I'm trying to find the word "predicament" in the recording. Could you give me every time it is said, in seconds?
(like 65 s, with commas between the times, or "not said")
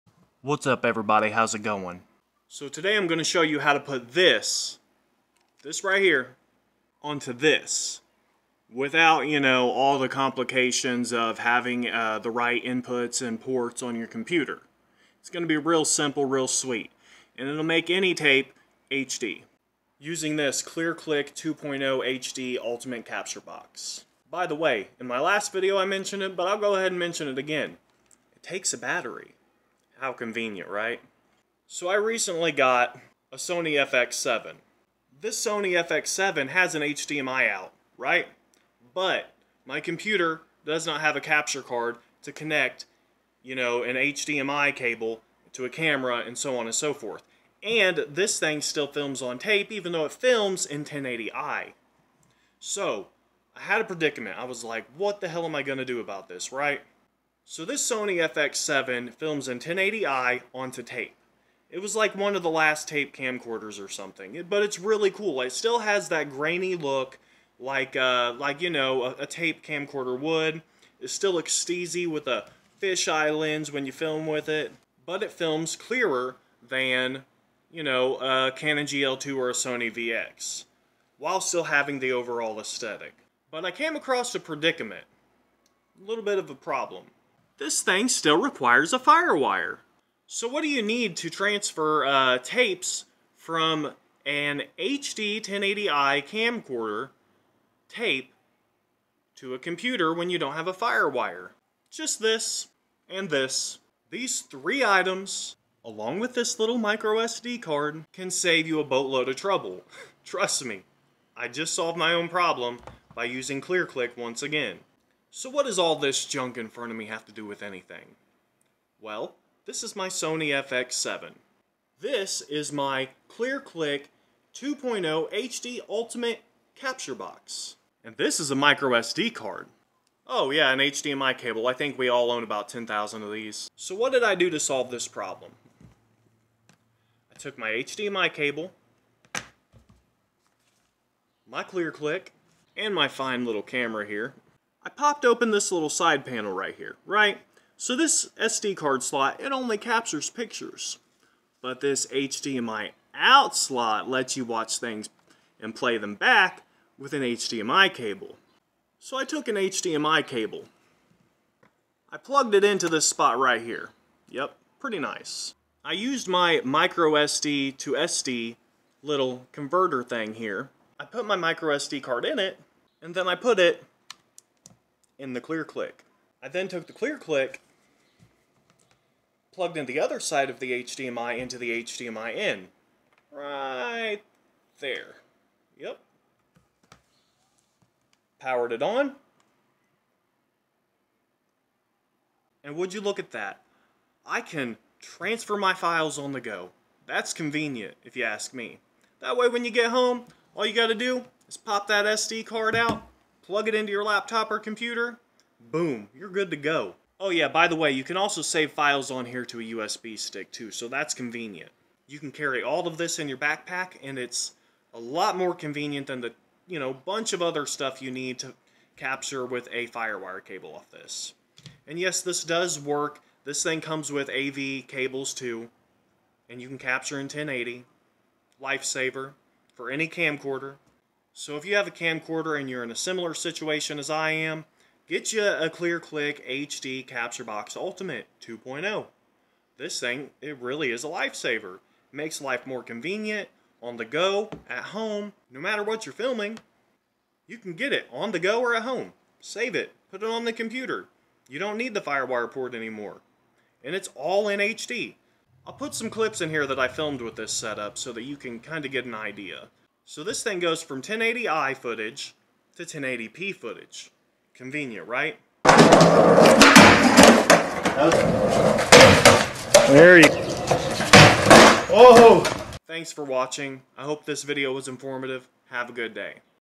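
53 s, 84 s.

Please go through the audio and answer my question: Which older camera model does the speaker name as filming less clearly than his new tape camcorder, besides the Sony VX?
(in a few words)
Canon GL2.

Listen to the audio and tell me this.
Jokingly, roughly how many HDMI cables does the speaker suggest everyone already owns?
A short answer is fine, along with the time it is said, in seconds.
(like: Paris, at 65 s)
10,000, at 132 s.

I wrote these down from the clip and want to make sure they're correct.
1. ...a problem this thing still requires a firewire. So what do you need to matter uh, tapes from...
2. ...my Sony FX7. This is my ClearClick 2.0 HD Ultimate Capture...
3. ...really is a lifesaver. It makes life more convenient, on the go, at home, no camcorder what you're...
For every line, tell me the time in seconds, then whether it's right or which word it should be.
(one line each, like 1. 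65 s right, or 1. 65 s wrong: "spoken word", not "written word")
1. 86 s wrong: "transfer", not "matter"
2. 119 s right
3. 240 s wrong: "matter", not "camcorder".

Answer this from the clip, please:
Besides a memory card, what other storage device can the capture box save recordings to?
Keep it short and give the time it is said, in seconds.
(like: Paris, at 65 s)
USB stick, at 209 s.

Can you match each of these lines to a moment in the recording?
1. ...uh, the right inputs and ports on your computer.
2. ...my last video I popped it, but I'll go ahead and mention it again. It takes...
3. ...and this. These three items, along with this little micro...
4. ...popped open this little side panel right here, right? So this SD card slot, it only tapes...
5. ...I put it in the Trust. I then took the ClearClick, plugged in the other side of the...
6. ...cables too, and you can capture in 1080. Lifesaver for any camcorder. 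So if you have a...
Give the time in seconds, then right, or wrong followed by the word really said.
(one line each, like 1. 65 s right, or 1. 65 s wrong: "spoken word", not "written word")
1. 11 s right
2. 25 s wrong: "mentioned", not "popped"
3. 103 s right
4. 144 s wrong: "captures", not "tapes"
5. 173 s wrong: "ClearClick", not "Trust"
6. 224 s right.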